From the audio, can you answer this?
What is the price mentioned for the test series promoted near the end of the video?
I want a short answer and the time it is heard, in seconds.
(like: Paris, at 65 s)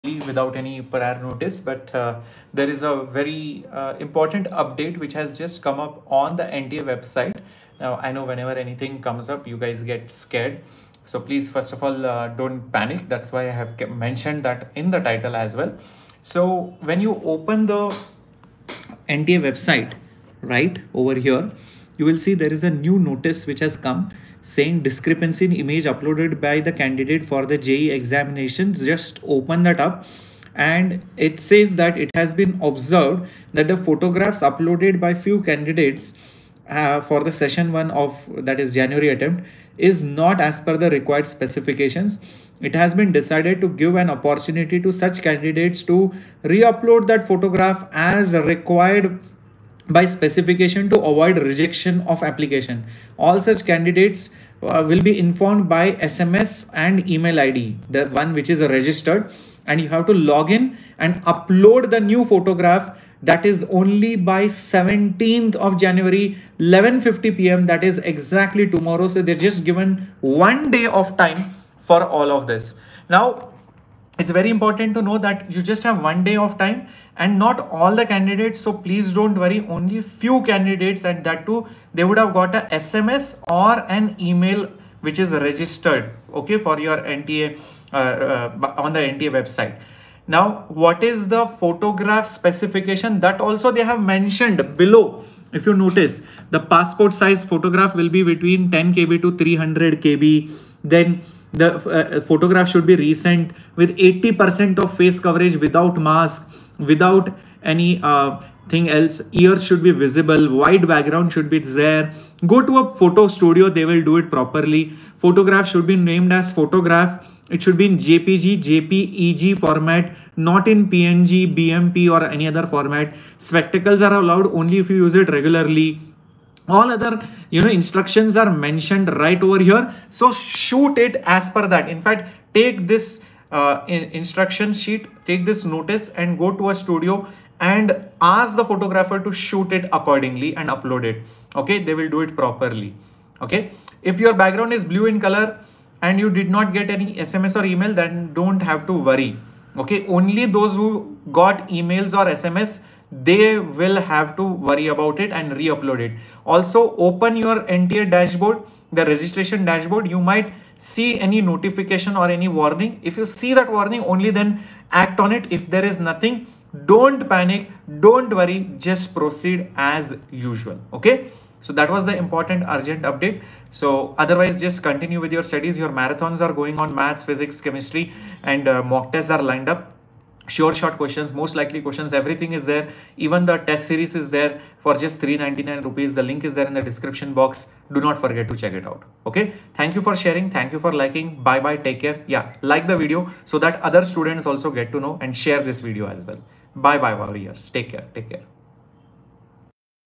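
399 rupees, at 185 s.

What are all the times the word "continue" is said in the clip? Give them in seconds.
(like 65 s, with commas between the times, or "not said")
174 s.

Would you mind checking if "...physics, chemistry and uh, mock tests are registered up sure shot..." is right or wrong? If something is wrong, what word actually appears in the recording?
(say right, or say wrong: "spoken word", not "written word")
wrong: "lined", not "registered".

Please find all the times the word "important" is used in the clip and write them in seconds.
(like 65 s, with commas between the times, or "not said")
3 s, 74 s, 172 s.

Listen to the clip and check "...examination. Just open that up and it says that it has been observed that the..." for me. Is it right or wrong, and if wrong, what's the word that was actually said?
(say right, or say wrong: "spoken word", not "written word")
right.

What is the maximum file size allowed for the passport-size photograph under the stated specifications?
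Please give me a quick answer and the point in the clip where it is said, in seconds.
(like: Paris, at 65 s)
300 kb, at 99 s.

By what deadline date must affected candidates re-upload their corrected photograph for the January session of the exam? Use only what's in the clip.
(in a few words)
17th of January.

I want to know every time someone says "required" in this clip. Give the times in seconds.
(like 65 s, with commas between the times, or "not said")
40 s, 48 s.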